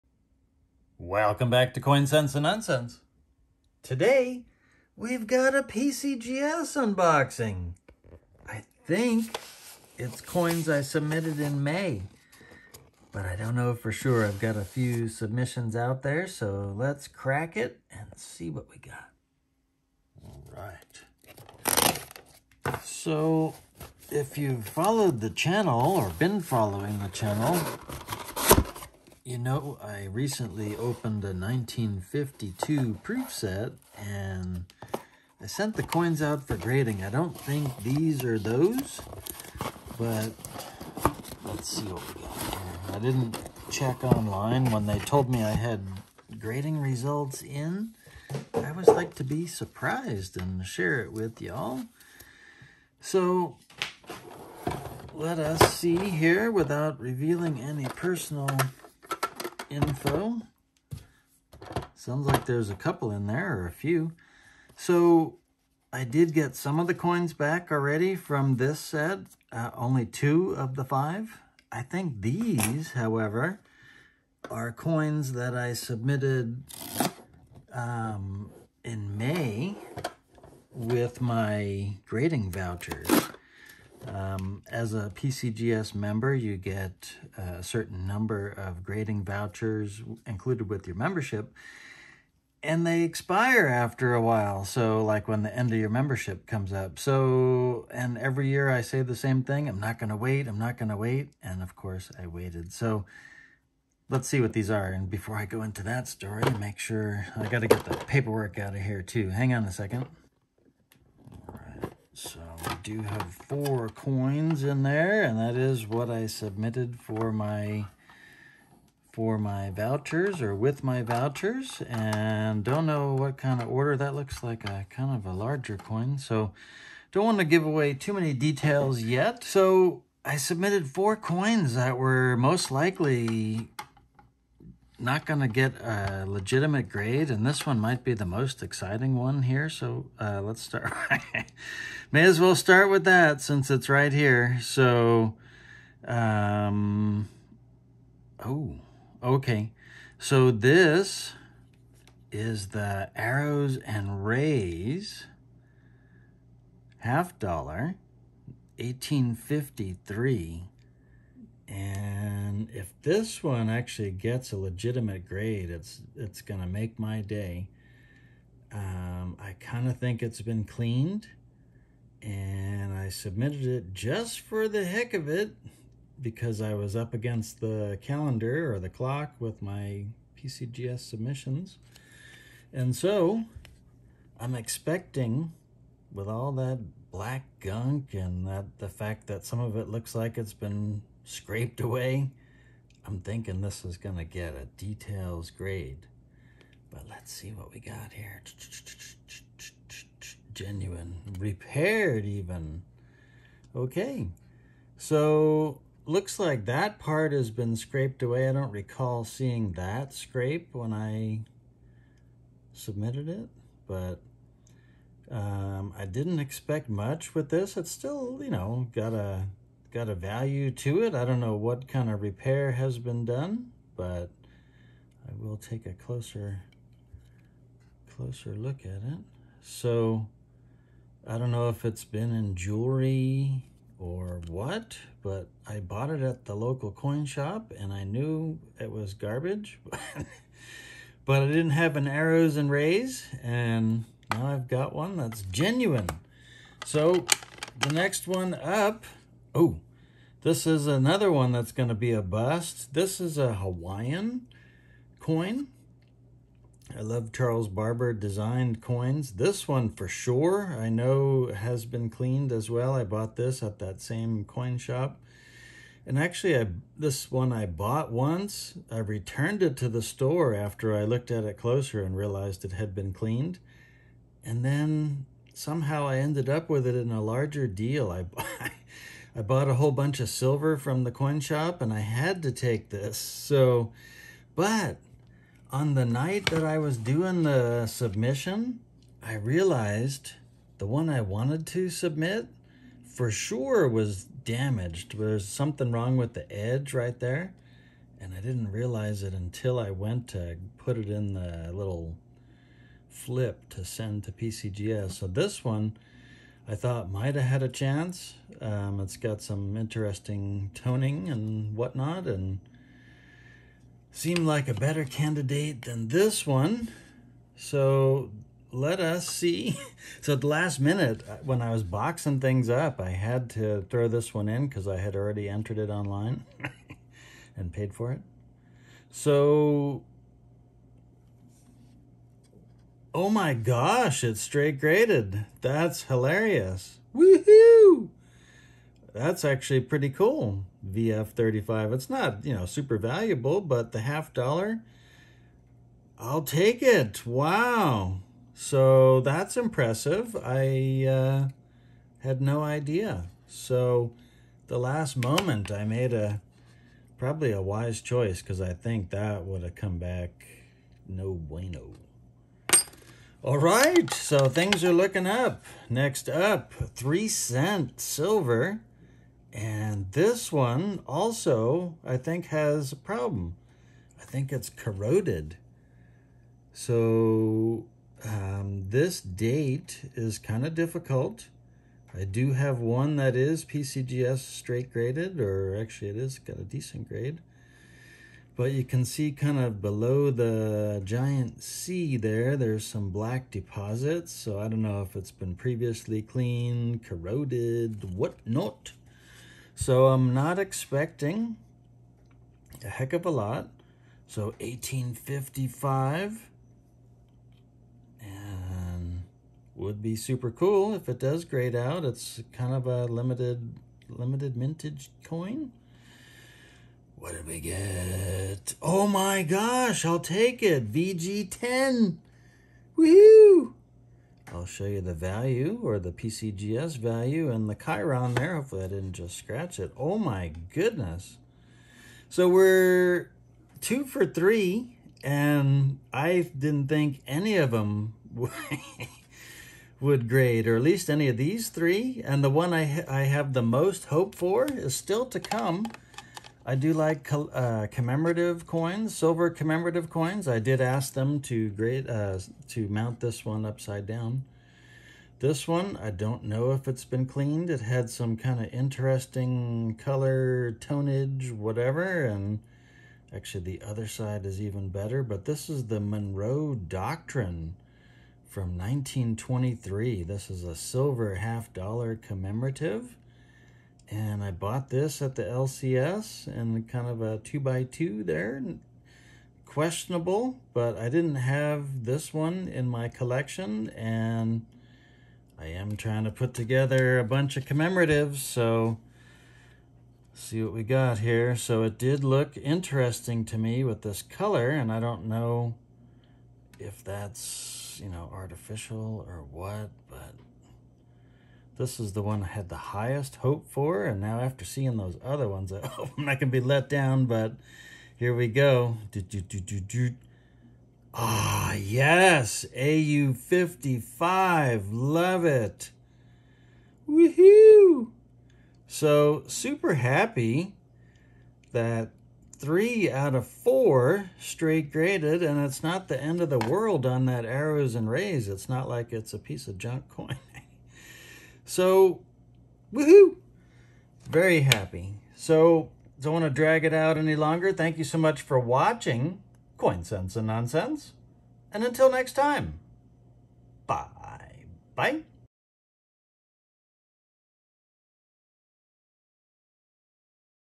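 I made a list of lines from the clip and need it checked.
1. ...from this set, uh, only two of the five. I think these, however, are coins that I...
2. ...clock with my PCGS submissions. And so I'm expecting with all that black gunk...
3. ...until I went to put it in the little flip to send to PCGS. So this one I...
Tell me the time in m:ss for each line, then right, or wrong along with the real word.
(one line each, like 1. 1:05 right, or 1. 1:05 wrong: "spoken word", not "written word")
1. 1:08 right
2. 2:58 right
3. 4:59 right.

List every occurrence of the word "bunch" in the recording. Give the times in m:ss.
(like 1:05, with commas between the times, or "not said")
4:39, 8:07.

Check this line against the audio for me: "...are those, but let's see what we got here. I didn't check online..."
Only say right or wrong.
right.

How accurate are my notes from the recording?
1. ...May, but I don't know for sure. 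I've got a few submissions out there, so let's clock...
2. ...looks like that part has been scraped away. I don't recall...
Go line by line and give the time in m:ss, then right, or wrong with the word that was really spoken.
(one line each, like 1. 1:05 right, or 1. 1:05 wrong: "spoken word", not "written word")
1. 0:11 wrong: "crack", not "clock"
2. 3:26 right.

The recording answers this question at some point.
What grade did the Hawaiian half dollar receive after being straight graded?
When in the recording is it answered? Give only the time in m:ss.
5:40.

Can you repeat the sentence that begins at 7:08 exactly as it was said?
Hopefully I didn't just scratch it.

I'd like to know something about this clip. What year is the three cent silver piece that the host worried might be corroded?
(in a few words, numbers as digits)
1855.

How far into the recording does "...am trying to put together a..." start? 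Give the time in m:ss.
8:05.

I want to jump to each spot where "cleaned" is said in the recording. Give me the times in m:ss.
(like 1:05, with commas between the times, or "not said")
2:50, 4:22, 4:33, 6:36, 7:37.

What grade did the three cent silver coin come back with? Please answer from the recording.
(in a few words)
VG10.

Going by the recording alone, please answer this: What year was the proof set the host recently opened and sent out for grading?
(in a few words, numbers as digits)
1952.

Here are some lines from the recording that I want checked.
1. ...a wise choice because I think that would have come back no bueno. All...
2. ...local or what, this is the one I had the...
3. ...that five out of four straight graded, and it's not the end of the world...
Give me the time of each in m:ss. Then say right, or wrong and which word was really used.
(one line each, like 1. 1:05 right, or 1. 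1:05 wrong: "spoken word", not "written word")
1. 5:57 right
2. 8:18 wrong: "artificial", not "local"
3. 8:41 wrong: "three", not "five".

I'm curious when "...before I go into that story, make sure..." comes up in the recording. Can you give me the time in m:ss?
1:45.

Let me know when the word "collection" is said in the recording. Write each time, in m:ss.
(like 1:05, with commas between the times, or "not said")
8:03.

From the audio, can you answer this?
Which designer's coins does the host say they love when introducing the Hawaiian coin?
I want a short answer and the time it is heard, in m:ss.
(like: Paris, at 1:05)
Charles Barber, at 4:17.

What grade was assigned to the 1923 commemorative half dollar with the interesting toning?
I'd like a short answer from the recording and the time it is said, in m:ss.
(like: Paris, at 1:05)
AU55, at 8:32.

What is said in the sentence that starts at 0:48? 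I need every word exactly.
I always like to be surprised and share it with y'all.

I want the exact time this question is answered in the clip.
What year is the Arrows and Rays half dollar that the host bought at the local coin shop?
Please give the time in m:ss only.
2:38.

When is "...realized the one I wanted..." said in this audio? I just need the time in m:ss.
4:49.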